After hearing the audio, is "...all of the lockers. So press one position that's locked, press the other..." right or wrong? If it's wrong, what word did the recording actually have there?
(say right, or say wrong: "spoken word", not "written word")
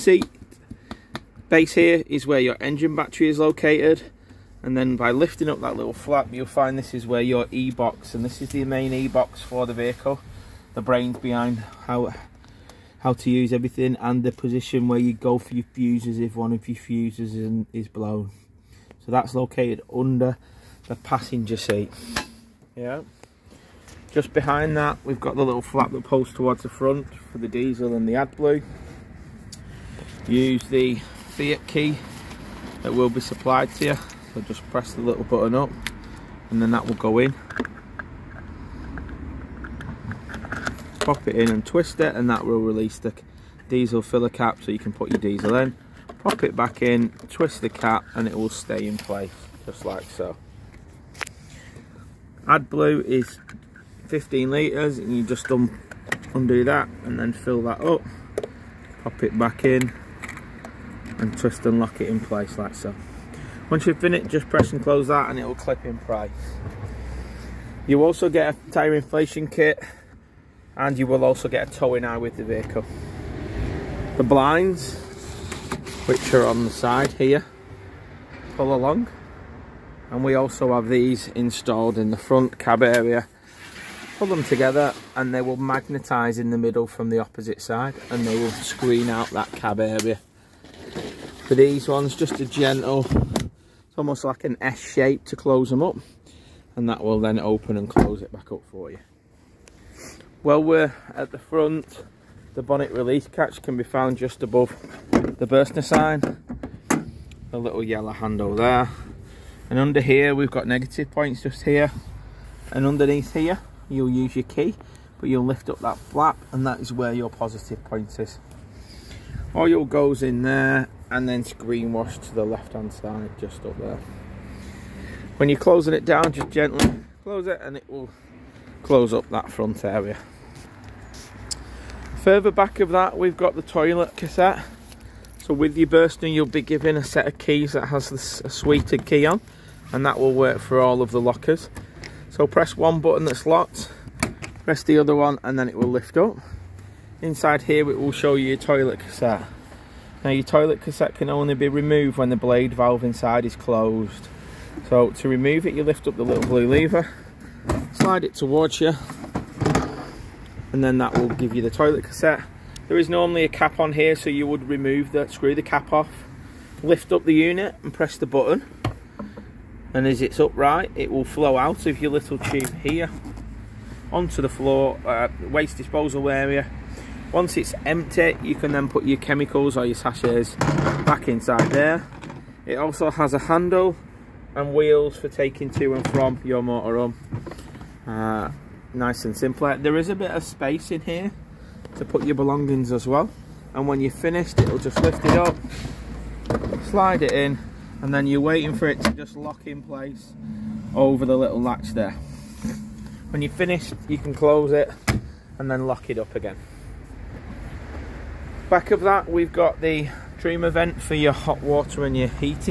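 wrong: "button", not "position".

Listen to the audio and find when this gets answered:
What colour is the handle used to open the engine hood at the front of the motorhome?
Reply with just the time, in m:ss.
1:47.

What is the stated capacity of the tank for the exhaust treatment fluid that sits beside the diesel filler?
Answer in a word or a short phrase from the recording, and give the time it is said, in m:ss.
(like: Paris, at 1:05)
15 litres, at 0:54.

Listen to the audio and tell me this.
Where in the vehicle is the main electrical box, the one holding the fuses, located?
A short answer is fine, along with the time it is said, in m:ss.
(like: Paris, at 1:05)
Under the passenger seat, at 0:19.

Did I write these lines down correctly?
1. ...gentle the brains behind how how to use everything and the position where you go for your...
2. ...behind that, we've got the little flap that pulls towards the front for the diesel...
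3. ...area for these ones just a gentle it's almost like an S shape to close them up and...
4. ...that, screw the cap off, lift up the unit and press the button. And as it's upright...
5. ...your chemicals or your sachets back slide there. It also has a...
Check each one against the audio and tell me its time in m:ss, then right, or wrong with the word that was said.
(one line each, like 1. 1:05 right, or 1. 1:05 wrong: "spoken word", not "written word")
1. 0:09 wrong: "vehicle", not "gentle"
2. 0:24 right
3. 1:29 right
4. 2:45 right
5. 2:59 wrong: "inside", not "slide".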